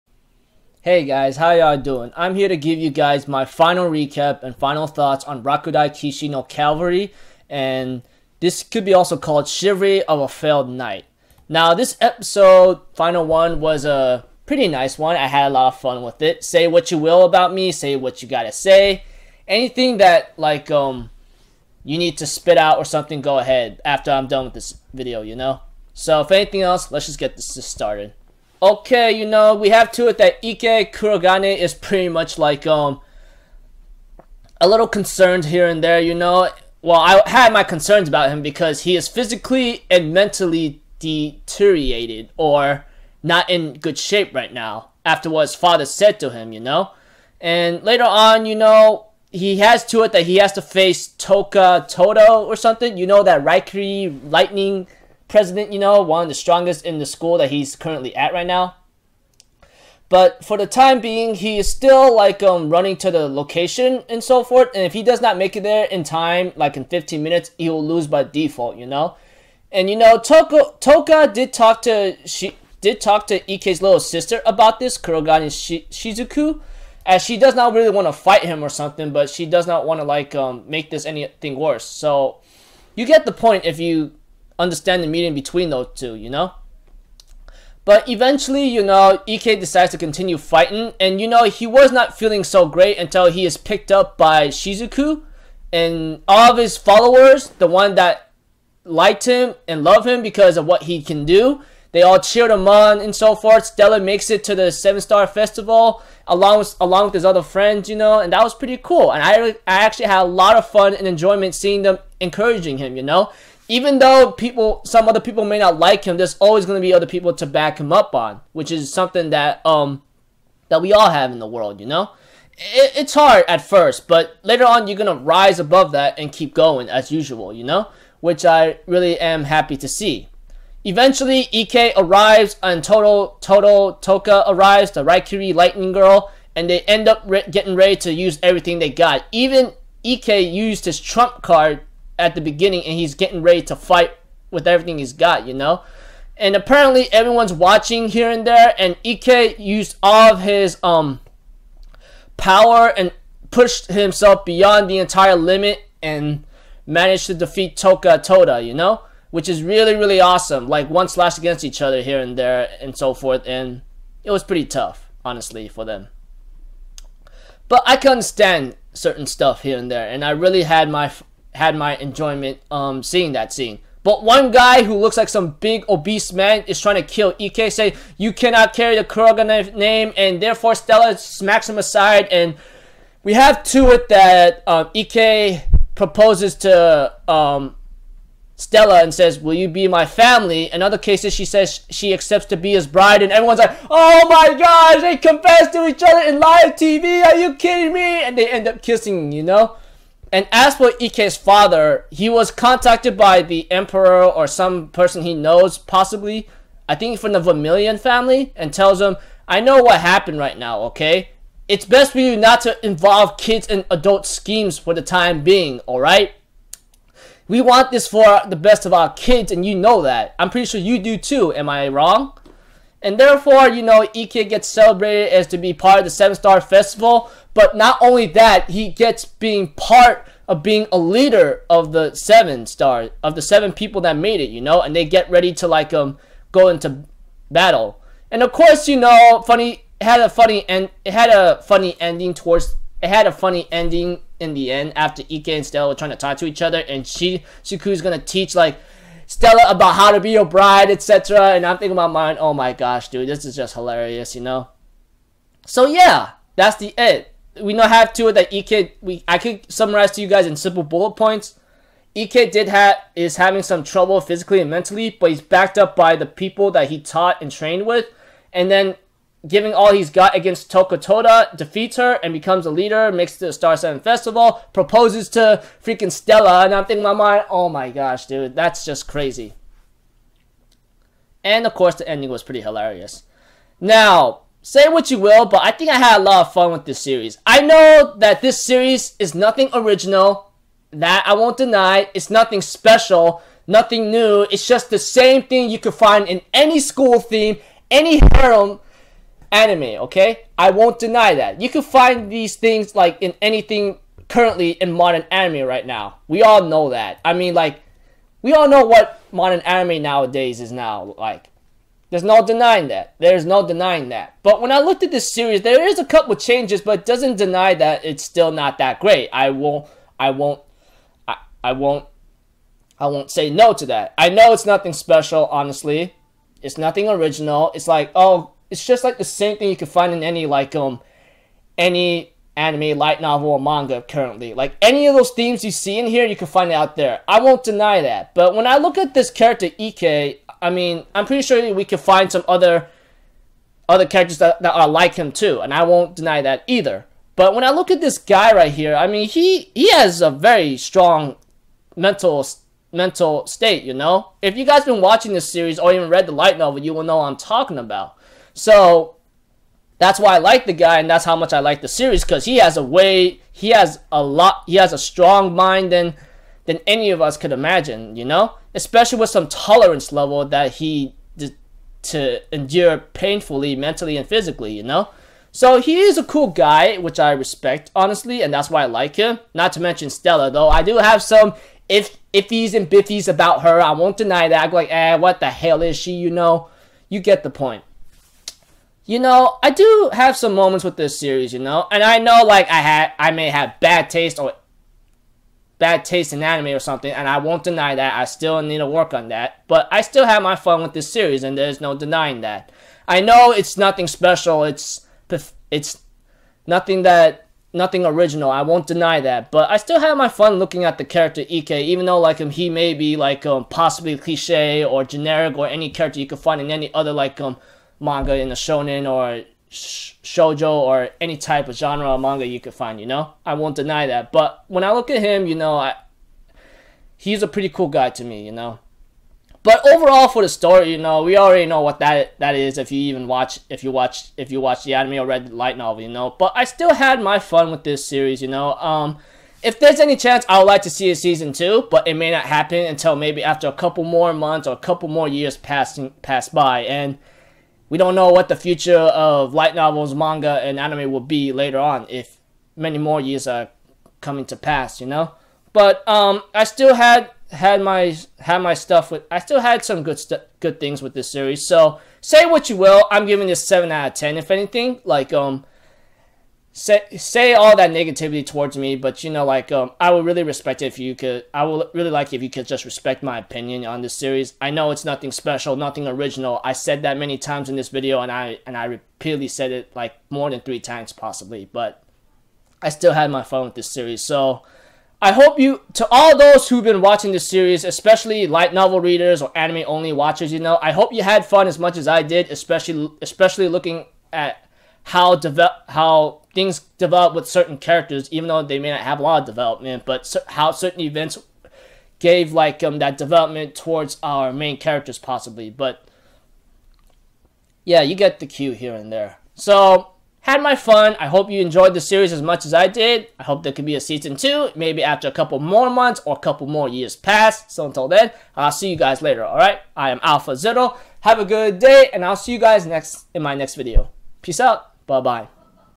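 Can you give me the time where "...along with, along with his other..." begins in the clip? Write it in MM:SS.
01:46.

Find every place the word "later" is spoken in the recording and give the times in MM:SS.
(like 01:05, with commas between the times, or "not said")
00:47, 02:04, 07:31, 08:39.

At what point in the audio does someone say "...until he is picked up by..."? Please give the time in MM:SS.
01:32.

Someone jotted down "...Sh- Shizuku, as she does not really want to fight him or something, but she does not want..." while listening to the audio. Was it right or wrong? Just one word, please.
right.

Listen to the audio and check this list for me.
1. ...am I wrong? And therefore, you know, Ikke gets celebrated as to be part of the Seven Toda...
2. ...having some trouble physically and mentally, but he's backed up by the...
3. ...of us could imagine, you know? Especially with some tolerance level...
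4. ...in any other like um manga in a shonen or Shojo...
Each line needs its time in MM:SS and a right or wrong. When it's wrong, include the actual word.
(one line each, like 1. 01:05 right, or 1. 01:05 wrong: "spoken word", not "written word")
1. 03:41 wrong: "Star", not "Toda"
2. 04:23 right
3. 06:07 right
4. 06:56 right.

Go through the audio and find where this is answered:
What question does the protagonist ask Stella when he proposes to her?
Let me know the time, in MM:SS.
03:09.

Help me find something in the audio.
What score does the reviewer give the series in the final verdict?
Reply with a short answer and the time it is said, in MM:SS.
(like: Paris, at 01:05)
7 out of 10, at 07:43.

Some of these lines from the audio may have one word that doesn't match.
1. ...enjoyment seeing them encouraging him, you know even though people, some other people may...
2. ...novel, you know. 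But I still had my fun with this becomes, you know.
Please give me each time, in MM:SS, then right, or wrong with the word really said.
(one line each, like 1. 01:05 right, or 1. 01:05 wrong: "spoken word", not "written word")
1. 01:51 right
2. 07:15 wrong: "series", not "becomes".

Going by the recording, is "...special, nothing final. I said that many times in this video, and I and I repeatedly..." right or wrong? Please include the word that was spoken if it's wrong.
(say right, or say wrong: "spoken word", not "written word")
wrong: "original", not "final".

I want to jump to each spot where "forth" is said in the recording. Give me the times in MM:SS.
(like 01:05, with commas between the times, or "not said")
01:04, 01:43, 02:43.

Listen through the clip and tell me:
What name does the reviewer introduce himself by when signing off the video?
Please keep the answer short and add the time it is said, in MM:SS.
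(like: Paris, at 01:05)
Alpha Zero, at 08:40.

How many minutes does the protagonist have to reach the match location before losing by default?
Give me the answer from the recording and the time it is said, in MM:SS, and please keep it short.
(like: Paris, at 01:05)
15, at 01:06.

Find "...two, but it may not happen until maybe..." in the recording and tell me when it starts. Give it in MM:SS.
07:21.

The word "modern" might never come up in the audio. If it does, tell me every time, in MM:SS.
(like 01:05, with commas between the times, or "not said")
05:04, 05:09.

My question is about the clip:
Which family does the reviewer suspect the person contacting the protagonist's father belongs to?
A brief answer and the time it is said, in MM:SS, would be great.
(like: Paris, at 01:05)
Vermillion, at 03:27.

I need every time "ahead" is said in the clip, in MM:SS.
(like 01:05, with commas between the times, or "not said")
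00:23.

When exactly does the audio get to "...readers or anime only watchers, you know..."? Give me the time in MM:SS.
08:08.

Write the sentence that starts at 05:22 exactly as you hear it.
I won't say no to that.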